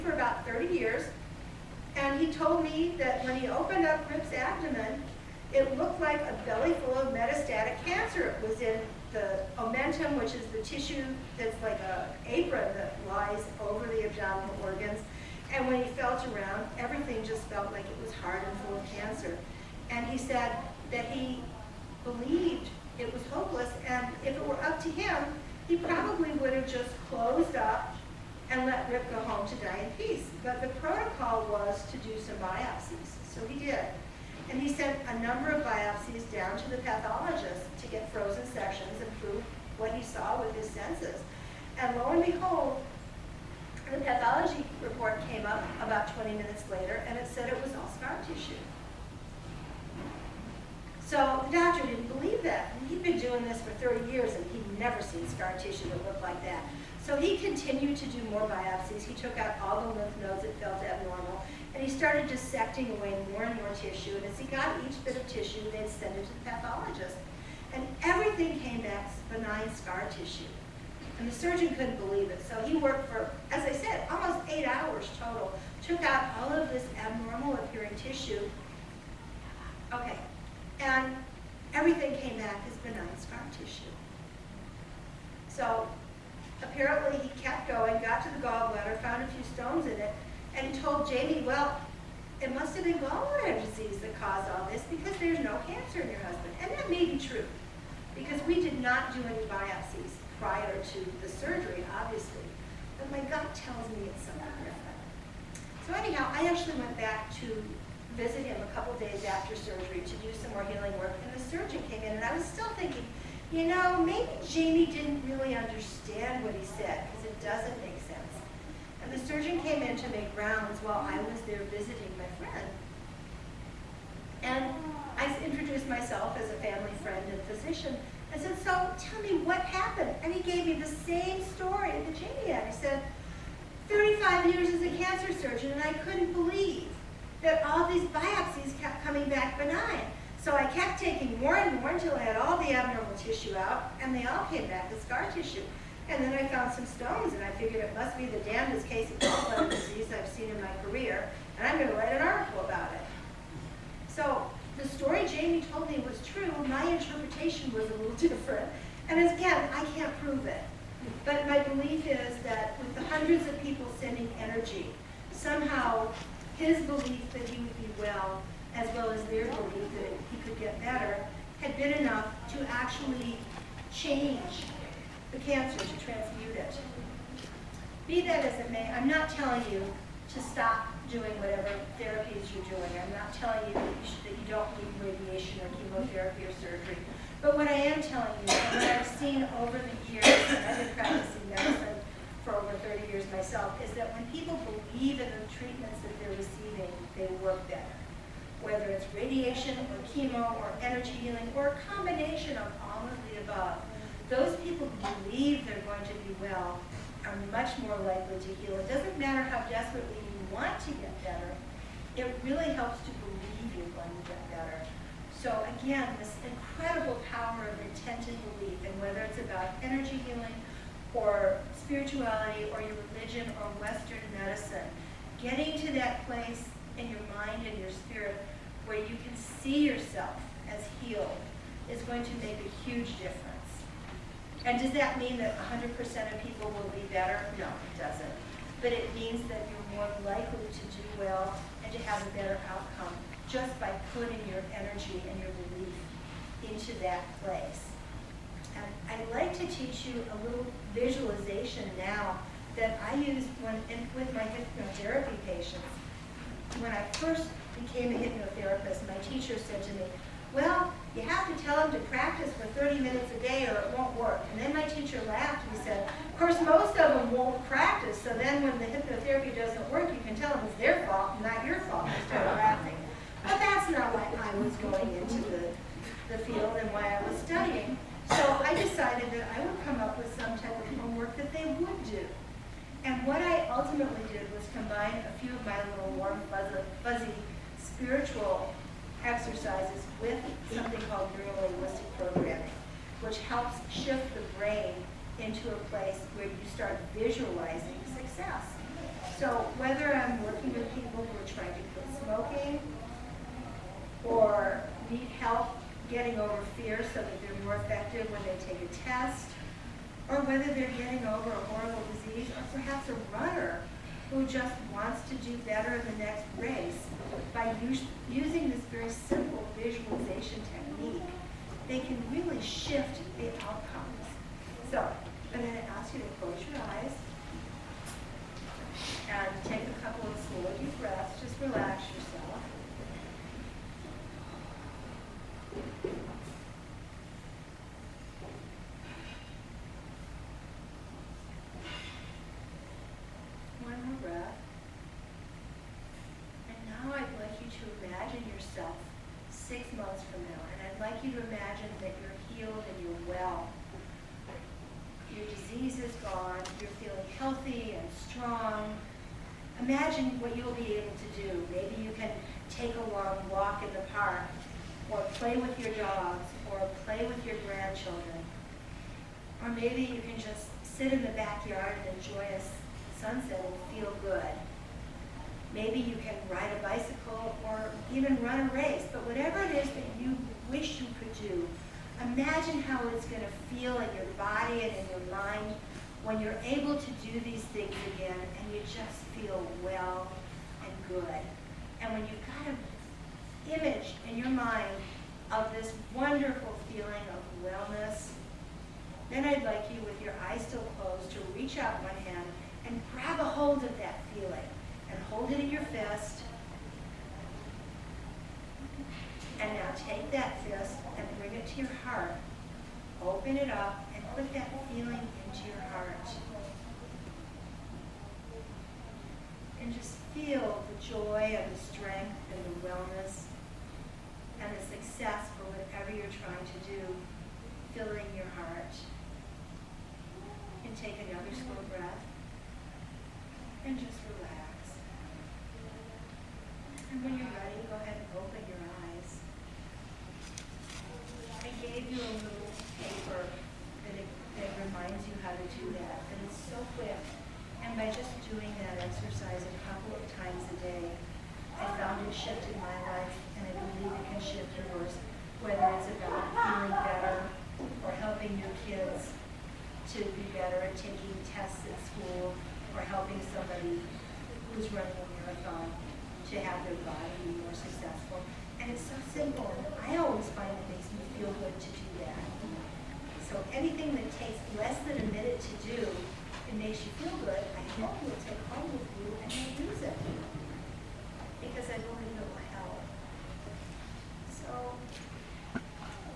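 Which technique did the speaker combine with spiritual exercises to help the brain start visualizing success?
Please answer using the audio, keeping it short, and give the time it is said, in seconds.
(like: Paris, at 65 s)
neurolinguistic programming, at 291 s.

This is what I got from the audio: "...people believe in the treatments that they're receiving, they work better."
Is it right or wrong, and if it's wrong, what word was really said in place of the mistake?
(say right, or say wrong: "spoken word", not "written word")
right.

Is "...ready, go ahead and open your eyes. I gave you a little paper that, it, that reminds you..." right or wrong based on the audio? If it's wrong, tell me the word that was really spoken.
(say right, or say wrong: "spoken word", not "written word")
right.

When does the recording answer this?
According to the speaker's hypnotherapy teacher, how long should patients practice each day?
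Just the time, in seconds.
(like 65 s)
262 s.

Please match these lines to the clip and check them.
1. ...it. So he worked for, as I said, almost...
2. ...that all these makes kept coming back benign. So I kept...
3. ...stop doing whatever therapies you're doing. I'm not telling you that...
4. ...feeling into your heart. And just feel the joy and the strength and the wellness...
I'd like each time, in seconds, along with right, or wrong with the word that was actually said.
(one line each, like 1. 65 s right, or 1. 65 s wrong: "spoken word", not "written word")
1. 72 s right
2. 137 s wrong: "biopsies", not "makes"
3. 180 s right
4. 414 s right.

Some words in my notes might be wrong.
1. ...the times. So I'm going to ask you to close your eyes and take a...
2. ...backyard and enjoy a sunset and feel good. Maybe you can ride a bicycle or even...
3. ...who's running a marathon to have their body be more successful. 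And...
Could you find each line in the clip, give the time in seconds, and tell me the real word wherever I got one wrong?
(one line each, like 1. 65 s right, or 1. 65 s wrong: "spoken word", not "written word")
1. 323 s wrong: "outcomes", not "times"
2. 371 s right
3. 464 s right.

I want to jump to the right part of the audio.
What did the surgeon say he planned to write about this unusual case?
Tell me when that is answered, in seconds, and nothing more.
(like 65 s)
152 s.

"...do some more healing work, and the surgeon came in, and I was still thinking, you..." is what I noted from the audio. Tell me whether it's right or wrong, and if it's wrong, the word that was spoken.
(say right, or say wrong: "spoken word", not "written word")
right.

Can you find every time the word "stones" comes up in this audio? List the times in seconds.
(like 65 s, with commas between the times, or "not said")
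89 s, 146 s.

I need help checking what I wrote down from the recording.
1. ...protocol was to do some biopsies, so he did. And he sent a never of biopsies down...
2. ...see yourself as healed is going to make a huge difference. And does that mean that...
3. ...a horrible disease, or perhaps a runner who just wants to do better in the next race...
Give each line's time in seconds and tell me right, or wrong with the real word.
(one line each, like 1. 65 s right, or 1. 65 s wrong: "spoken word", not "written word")
1. 30 s wrong: "number", not "never"
2. 229 s right
3. 311 s right.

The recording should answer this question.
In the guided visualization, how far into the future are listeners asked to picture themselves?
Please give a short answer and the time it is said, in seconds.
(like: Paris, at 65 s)
6 months, at 349 s.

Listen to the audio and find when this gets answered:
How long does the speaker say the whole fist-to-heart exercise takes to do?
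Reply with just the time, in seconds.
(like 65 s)
474 s.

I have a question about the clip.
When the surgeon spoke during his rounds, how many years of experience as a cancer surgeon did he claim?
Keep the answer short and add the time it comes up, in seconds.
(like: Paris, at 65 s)
35 years, at 133 s.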